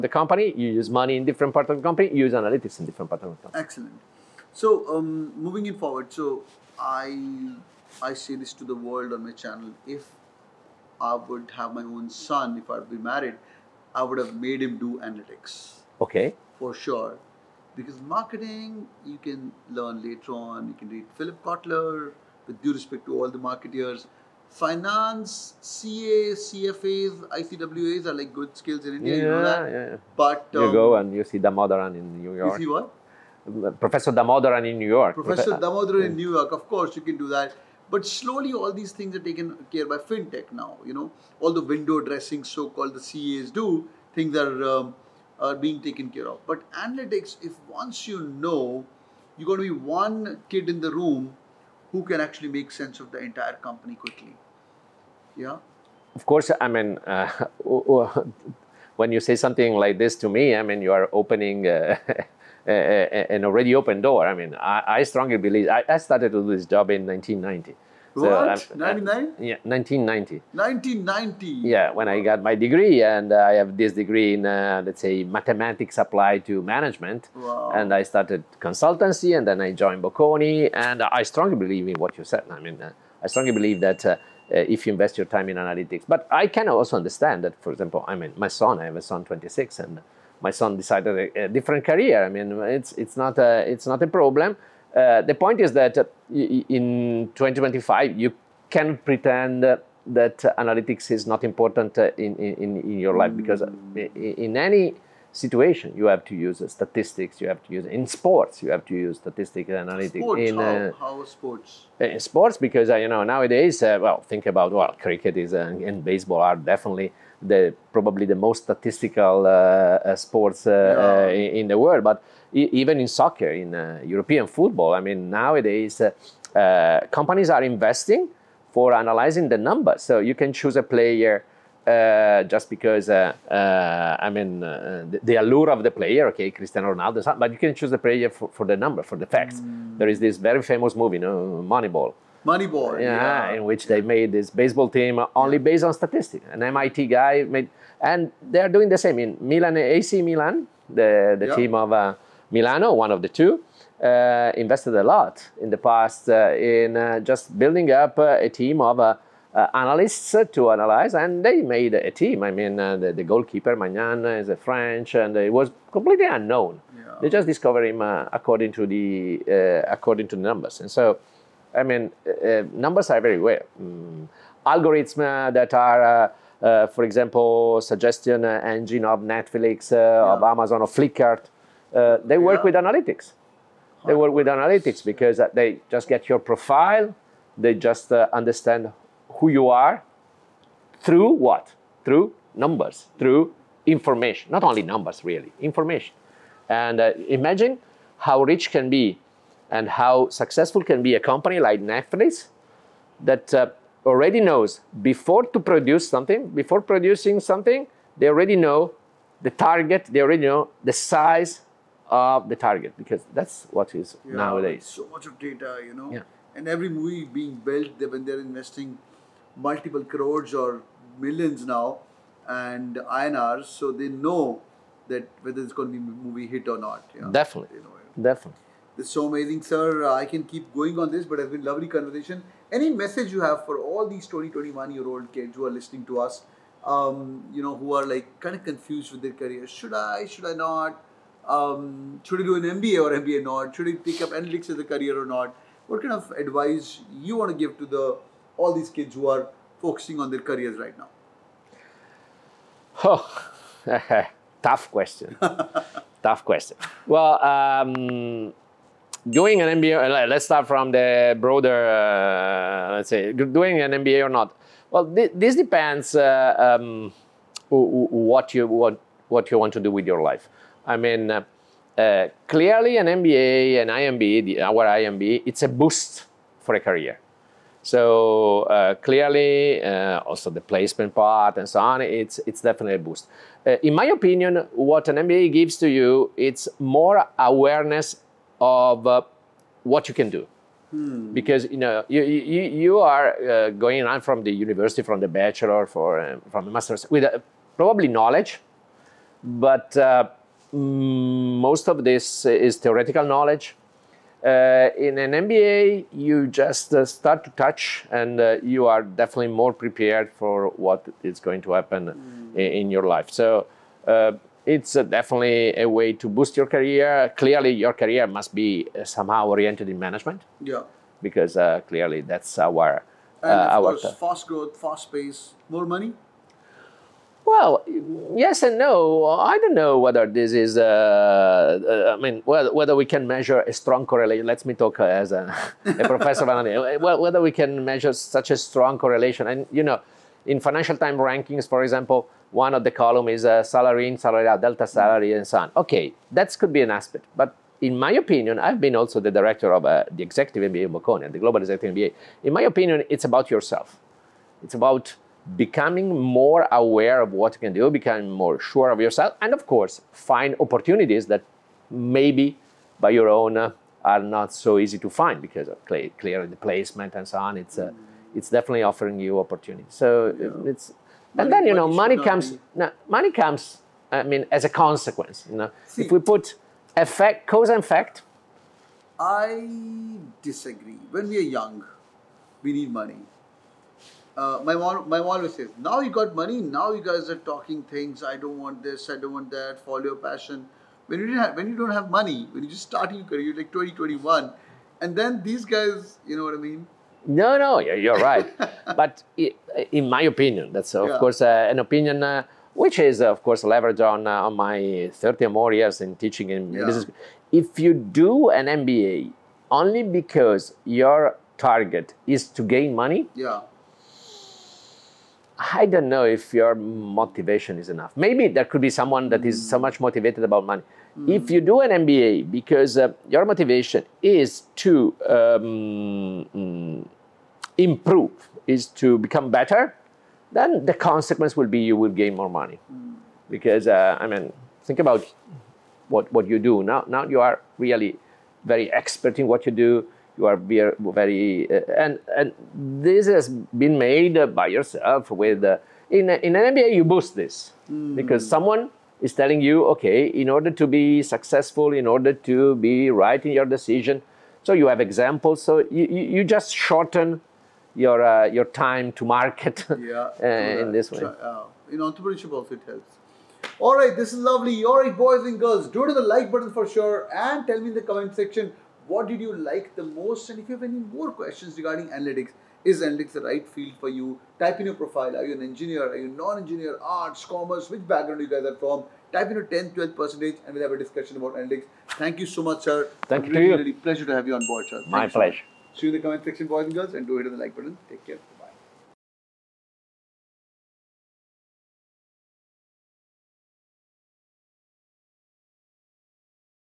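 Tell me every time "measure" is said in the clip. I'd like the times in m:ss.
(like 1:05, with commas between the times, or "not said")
5:33, 5:37.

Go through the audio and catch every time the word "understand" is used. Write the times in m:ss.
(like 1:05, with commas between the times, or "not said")
1:26, 3:08.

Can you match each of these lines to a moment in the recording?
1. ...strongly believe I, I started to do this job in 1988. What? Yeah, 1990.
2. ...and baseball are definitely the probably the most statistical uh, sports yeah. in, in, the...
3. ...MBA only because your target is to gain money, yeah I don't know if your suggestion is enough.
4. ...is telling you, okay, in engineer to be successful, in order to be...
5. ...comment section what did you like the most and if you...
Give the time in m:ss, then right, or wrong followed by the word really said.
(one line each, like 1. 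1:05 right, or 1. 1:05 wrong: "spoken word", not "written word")
1. 1:05 wrong: "1990", not "1988"
2. 1:55 right
3. 6:48 wrong: "motivation", not "suggestion"
4. 7:29 wrong: "order", not "engineer"
5. 7:48 right.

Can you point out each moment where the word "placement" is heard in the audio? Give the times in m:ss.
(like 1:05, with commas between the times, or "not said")
4:40, 6:06.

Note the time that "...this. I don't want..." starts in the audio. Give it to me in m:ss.
6:28.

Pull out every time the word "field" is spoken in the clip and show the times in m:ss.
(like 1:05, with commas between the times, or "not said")
7:53.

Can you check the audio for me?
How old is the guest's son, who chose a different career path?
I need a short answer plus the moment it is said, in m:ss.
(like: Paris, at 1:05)
26, at 1:29.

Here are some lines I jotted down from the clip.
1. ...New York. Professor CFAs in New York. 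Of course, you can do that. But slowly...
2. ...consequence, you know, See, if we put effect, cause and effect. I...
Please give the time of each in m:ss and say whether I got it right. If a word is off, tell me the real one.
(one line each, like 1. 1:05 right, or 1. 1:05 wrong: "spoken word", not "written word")
1. 0:34 wrong: "Damodaran", not "CFAs"
2. 6:14 right.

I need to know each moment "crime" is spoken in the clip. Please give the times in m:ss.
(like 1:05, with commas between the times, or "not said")
not said.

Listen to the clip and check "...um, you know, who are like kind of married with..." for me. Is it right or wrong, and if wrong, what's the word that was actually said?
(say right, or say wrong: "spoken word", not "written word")
wrong: "confused", not "married".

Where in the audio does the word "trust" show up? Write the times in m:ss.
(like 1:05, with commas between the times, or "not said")
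not said.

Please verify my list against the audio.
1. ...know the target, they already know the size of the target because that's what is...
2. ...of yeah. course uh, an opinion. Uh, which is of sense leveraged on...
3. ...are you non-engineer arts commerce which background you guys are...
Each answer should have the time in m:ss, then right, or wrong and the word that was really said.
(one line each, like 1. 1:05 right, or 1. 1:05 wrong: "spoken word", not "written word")
1. 3:28 right
2. 6:40 wrong: "course", not "sense"
3. 7:56 right.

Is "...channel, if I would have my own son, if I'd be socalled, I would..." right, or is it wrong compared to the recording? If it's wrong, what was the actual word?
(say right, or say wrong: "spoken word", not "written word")
wrong: "married", not "socalled".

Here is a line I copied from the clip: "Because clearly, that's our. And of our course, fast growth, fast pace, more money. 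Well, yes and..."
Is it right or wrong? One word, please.
right.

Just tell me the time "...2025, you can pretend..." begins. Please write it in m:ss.
1:37.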